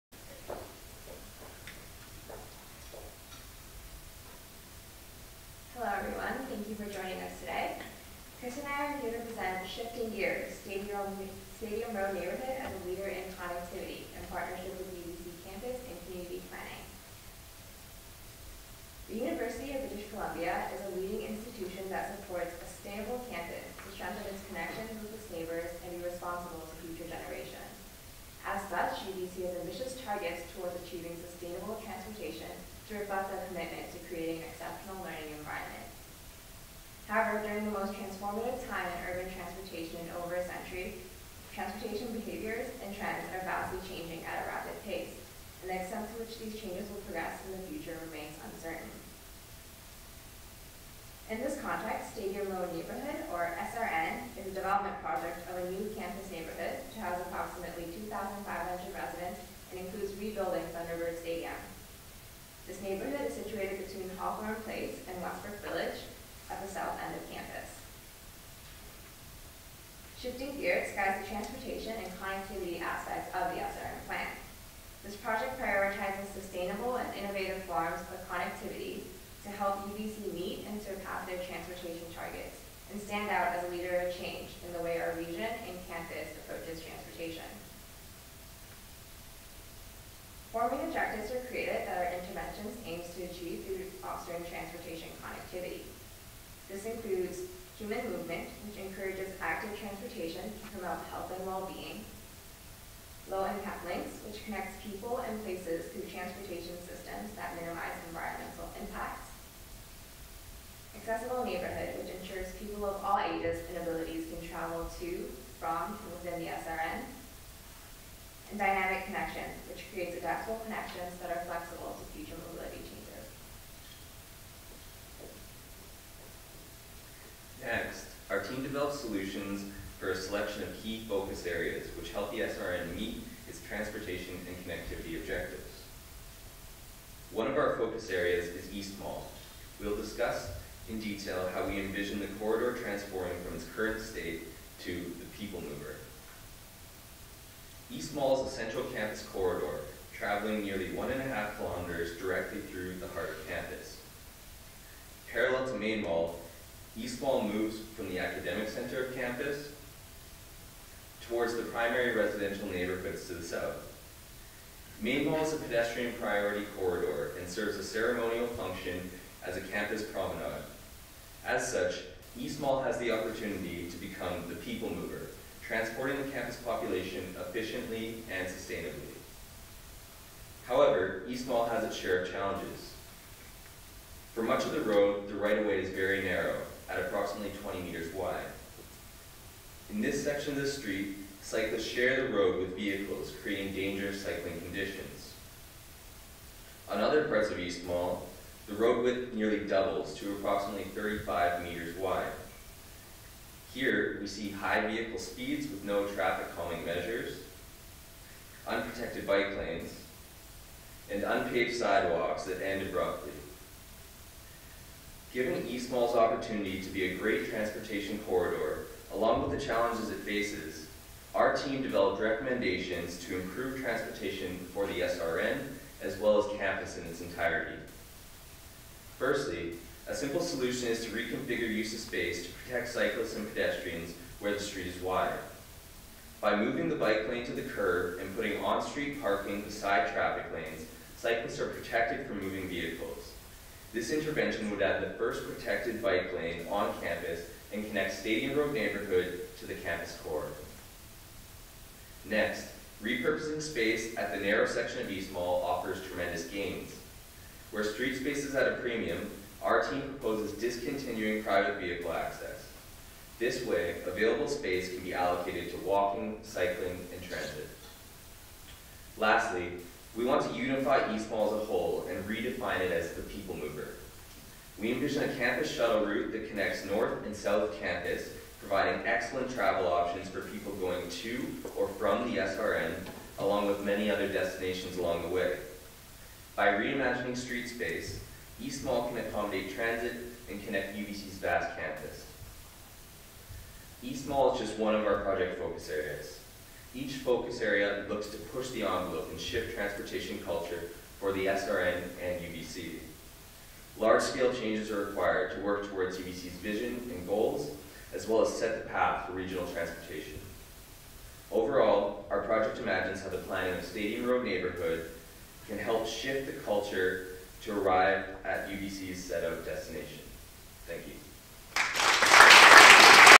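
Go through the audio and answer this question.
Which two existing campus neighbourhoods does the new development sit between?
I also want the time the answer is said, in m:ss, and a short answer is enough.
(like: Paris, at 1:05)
Hawthorn Place and Wesbrook Village, at 1:04.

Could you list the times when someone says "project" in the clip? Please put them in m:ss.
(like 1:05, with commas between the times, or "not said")
0:55, 1:15, 4:55, 5:12.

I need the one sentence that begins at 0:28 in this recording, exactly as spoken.
As such, UBC has ambitious targets towards achieving sustainable transportation to reflect their commitment to creating exceptional learning environment.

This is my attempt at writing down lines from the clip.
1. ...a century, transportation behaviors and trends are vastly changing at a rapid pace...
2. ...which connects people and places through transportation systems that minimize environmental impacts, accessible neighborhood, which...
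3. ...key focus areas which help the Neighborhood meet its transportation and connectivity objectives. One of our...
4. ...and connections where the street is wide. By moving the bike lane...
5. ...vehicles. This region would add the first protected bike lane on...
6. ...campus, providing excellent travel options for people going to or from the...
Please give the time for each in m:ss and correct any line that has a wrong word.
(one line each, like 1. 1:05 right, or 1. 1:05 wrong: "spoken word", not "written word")
1. 0:40 right
2. 1:44 right
3. 2:10 wrong: "SRN", not "Neighborhood"
4. 3:53 wrong: "pedestrians", not "connections"
5. 4:02 wrong: "intervention", not "region"
6. 4:37 right.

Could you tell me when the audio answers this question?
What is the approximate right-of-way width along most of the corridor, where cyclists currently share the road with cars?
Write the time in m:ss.
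3:07.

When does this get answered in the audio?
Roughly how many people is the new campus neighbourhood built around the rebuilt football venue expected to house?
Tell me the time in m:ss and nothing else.
0:57.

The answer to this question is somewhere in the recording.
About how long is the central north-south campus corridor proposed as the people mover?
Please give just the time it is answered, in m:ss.
2:30.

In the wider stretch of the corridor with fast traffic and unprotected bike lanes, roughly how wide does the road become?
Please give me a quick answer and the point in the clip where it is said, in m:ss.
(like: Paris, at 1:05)
35 meters, at 3:20.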